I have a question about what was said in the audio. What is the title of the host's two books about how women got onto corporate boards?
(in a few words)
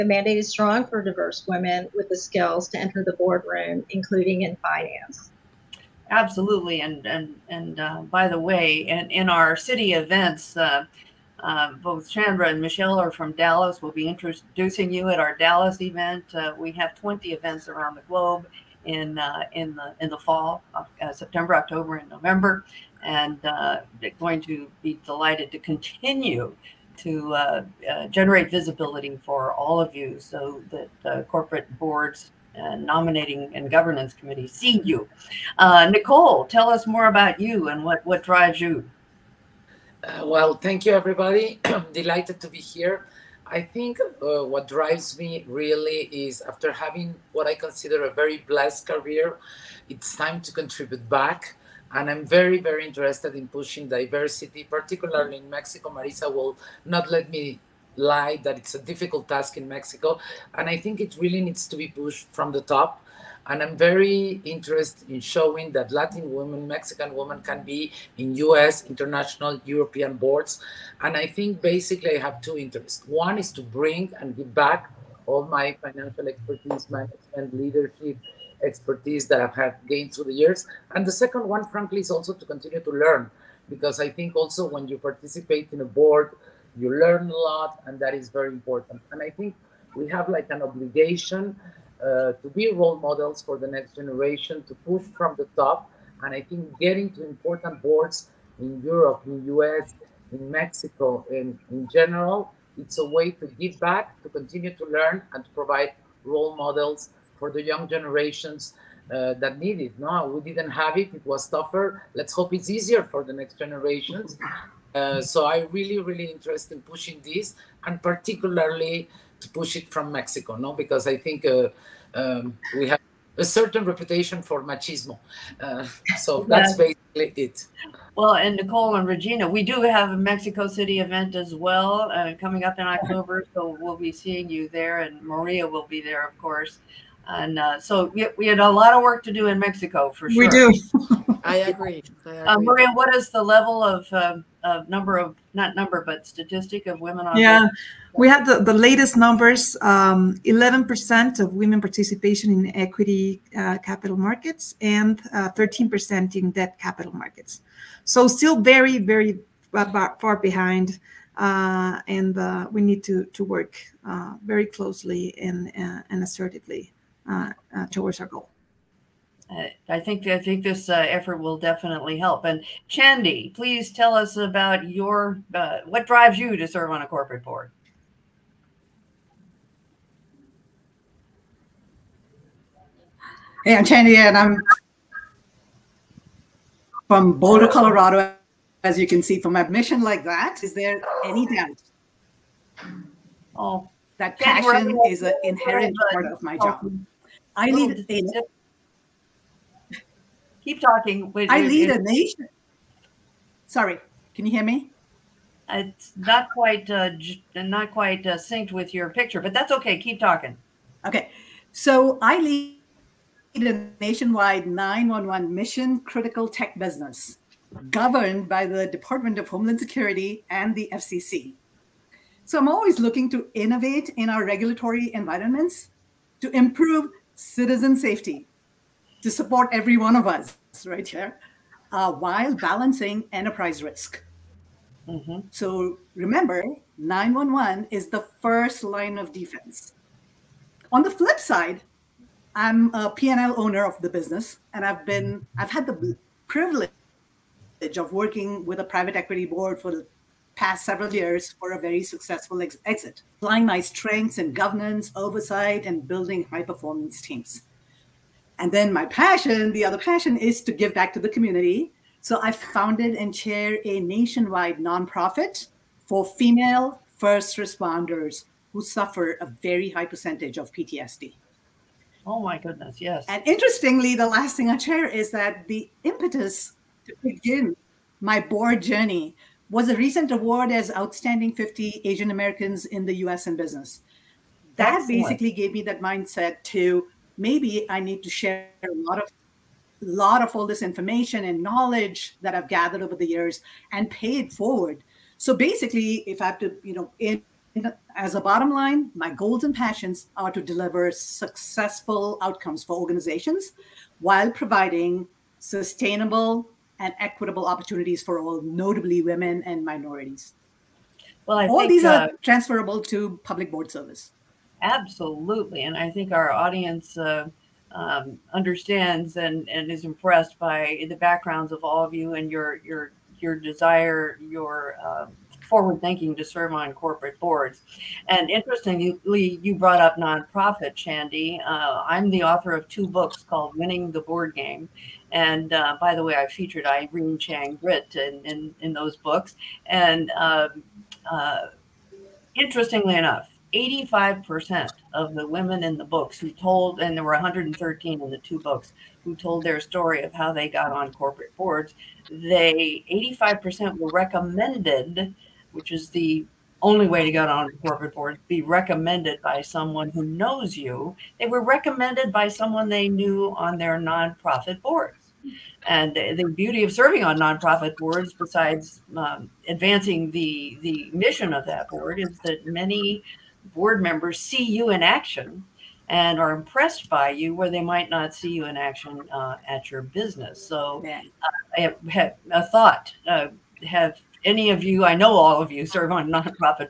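Winning the Board Game.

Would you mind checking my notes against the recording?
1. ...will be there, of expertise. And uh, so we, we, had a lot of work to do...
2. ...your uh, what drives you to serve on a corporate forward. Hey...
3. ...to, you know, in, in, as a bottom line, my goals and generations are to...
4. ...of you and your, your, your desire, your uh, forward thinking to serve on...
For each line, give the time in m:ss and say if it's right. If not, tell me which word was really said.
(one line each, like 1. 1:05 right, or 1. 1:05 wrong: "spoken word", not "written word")
1. 2:15 wrong: "course", not "expertise"
2. 2:54 wrong: "board", not "forward"
3. 4:56 wrong: "passions", not "generations"
4. 5:22 right.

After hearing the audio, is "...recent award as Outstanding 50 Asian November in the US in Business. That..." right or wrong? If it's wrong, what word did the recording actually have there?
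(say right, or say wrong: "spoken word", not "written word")
wrong: "Americans", not "November".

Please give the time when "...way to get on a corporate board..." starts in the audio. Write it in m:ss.
5:57.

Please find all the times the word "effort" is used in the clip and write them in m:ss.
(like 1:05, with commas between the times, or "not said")
2:51.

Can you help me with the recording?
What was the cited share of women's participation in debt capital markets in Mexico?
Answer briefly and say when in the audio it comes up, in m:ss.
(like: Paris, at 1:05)
13%, at 2:35.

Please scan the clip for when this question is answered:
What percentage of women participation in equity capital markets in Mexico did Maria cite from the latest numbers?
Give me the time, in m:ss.
2:30.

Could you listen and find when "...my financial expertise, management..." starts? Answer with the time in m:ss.
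1:15.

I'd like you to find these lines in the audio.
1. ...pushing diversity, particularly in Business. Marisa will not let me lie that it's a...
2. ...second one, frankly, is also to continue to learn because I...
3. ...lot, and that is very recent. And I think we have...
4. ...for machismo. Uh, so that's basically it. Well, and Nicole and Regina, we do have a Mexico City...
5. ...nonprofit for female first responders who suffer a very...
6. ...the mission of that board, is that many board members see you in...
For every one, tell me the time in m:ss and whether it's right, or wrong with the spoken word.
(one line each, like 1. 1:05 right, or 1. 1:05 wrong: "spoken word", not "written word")
1. 0:53 wrong: "Mexico", not "Business"
2. 1:21 right
3. 1:27 wrong: "important", not "recent"
4. 2:04 right
5. 4:24 right
6. 6:10 right.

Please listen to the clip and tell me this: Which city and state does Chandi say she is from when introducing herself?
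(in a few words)
Boulder, Colorado.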